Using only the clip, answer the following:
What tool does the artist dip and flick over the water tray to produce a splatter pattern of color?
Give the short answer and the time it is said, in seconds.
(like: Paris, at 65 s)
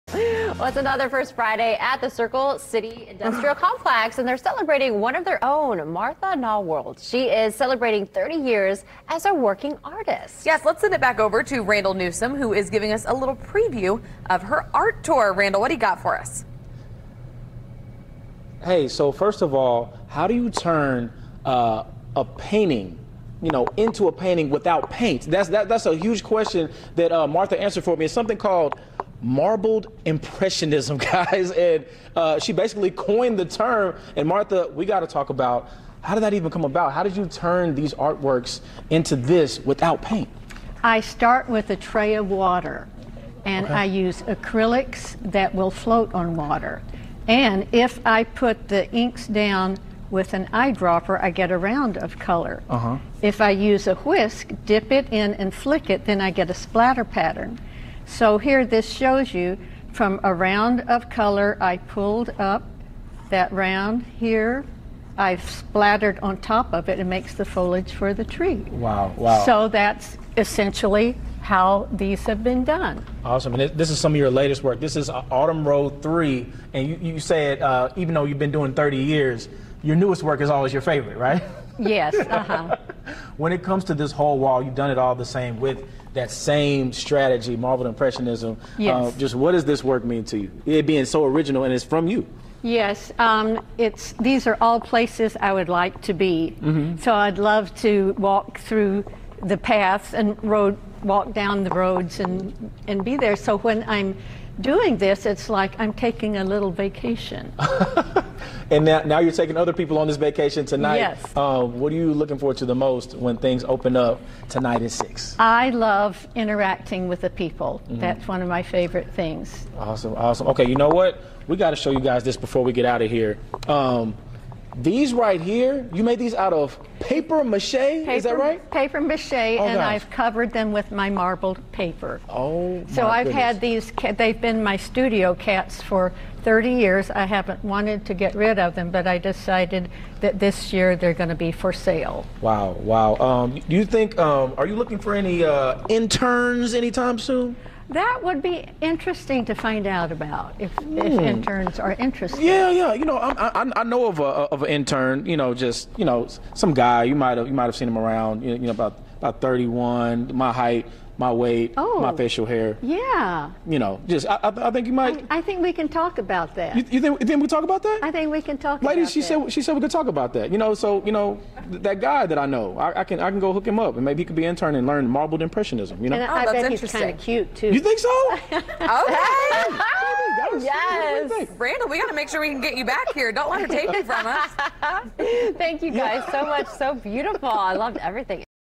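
whisk, at 54 s.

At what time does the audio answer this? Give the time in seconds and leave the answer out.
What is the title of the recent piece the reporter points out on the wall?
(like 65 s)
75 s.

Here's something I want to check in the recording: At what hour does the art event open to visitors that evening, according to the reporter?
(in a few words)
6.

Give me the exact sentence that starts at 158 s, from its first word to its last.
You know, about about 31, my height, my weight, oh, my facial hair.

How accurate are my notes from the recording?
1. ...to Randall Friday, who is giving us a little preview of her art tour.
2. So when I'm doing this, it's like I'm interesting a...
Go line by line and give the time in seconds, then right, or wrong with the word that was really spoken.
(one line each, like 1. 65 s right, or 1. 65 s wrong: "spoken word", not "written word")
1. 11 s wrong: "Newsom", not "Friday"
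2. 103 s wrong: "taking", not "interesting".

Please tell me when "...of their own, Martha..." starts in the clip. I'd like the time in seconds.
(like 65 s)
5 s.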